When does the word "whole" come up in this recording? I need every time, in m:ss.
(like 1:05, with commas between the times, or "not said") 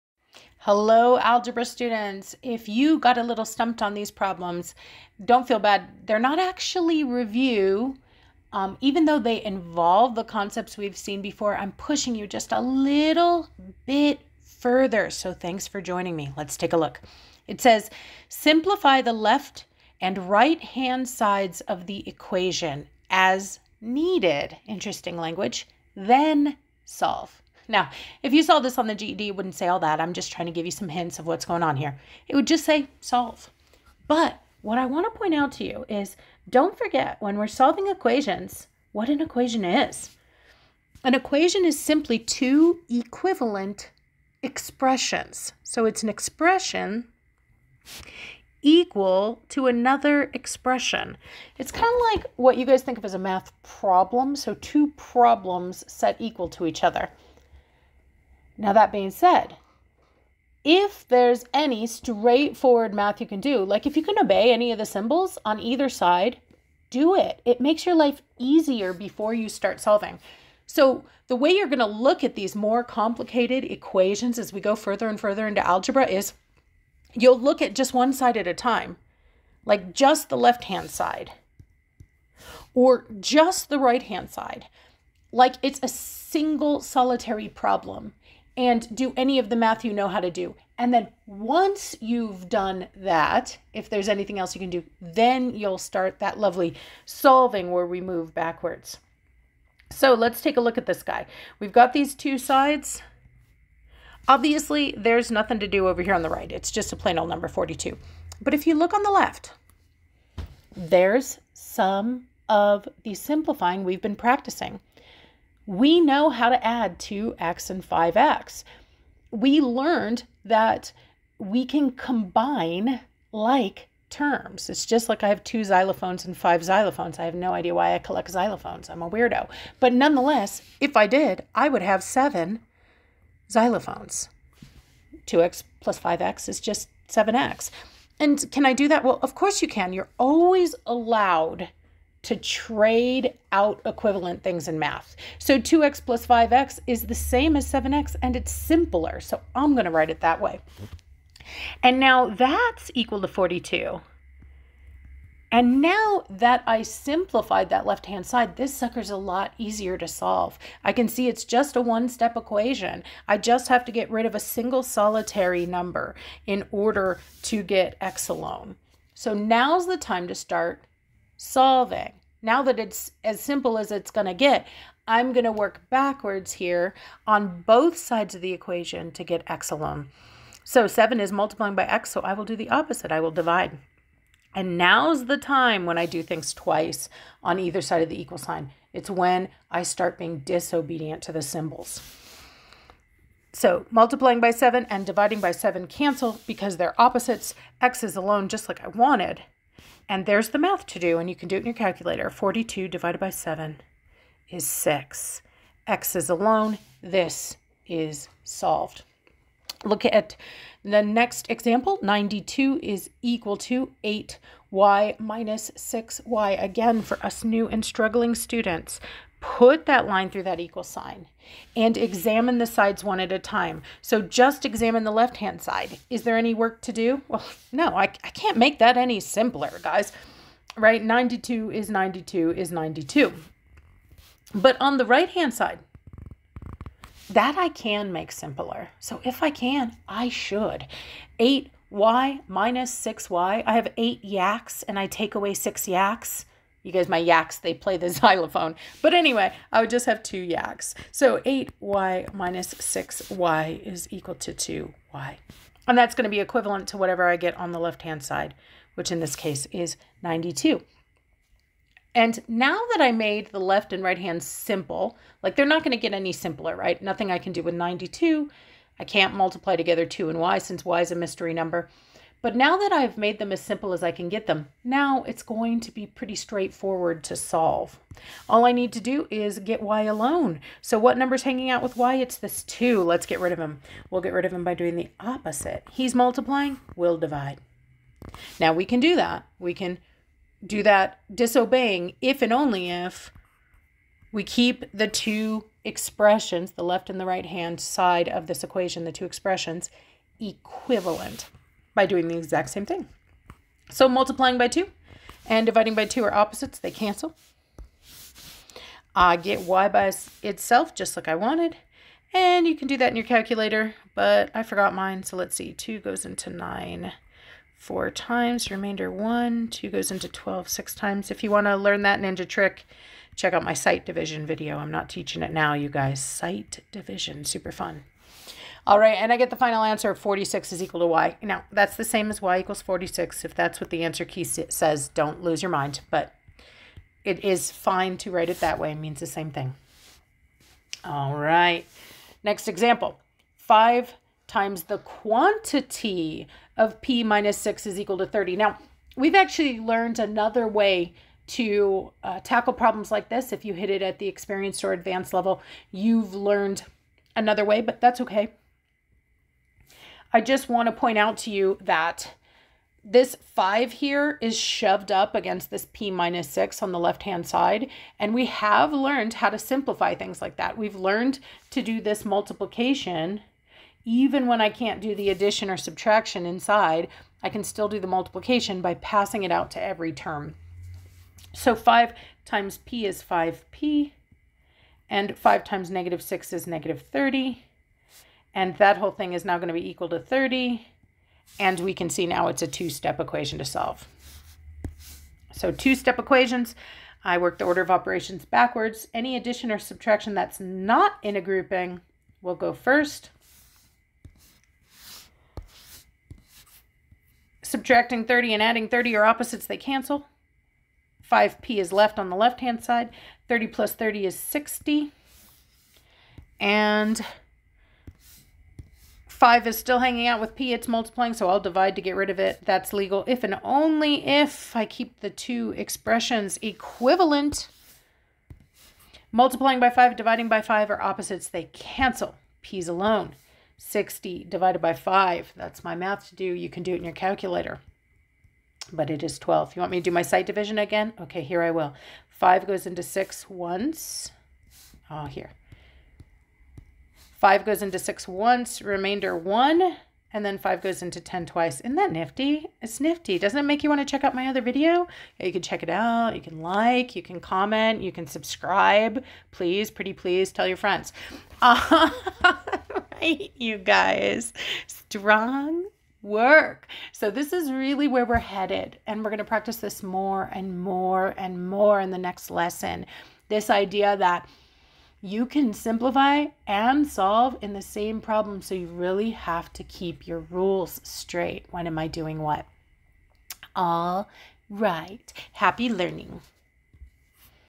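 6:28.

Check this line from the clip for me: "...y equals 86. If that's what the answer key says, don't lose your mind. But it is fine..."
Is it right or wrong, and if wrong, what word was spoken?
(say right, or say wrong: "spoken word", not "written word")
wrong: "46", not "86".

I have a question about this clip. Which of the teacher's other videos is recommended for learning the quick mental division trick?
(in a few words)
sight division video.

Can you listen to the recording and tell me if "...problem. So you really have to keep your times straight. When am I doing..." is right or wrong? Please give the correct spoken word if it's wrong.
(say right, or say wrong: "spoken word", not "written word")
wrong: "rules", not "times".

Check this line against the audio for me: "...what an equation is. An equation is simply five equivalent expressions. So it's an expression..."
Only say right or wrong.
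wrong.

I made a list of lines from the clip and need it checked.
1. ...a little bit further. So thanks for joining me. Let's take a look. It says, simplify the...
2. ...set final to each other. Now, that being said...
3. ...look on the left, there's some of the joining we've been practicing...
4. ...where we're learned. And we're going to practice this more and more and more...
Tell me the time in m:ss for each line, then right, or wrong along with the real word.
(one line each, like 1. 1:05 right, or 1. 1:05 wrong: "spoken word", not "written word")
1. 0:12 right
2. 0:55 wrong: "equal", not "final"
3. 1:48 wrong: "simplifying", not "joining"
4. 7:48 wrong: "headed", not "learned".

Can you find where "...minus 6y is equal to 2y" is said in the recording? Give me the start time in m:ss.
4:12.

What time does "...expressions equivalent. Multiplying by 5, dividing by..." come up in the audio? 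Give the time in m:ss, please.
7:05.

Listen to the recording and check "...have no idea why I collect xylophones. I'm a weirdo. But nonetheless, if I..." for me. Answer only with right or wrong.
right.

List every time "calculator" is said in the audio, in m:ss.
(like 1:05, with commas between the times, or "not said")
3:21, 5:13, 7:17.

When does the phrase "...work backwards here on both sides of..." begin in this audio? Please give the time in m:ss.
2:55.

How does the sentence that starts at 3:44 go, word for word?
So just examine the left-hand side.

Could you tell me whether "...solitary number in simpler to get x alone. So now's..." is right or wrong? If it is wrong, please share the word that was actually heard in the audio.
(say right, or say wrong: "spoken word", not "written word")
wrong: "order", not "simpler".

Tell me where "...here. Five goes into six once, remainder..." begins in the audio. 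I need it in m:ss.
7:25.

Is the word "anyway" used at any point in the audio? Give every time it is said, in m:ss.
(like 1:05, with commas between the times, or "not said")
4:09.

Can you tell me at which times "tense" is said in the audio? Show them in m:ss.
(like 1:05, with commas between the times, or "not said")
not said.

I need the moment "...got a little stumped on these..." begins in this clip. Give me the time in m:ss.
0:02.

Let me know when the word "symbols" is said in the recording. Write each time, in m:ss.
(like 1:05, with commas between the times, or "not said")
1:04, 3:11.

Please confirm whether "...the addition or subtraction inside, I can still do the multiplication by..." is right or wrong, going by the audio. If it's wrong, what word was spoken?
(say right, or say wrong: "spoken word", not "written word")
right.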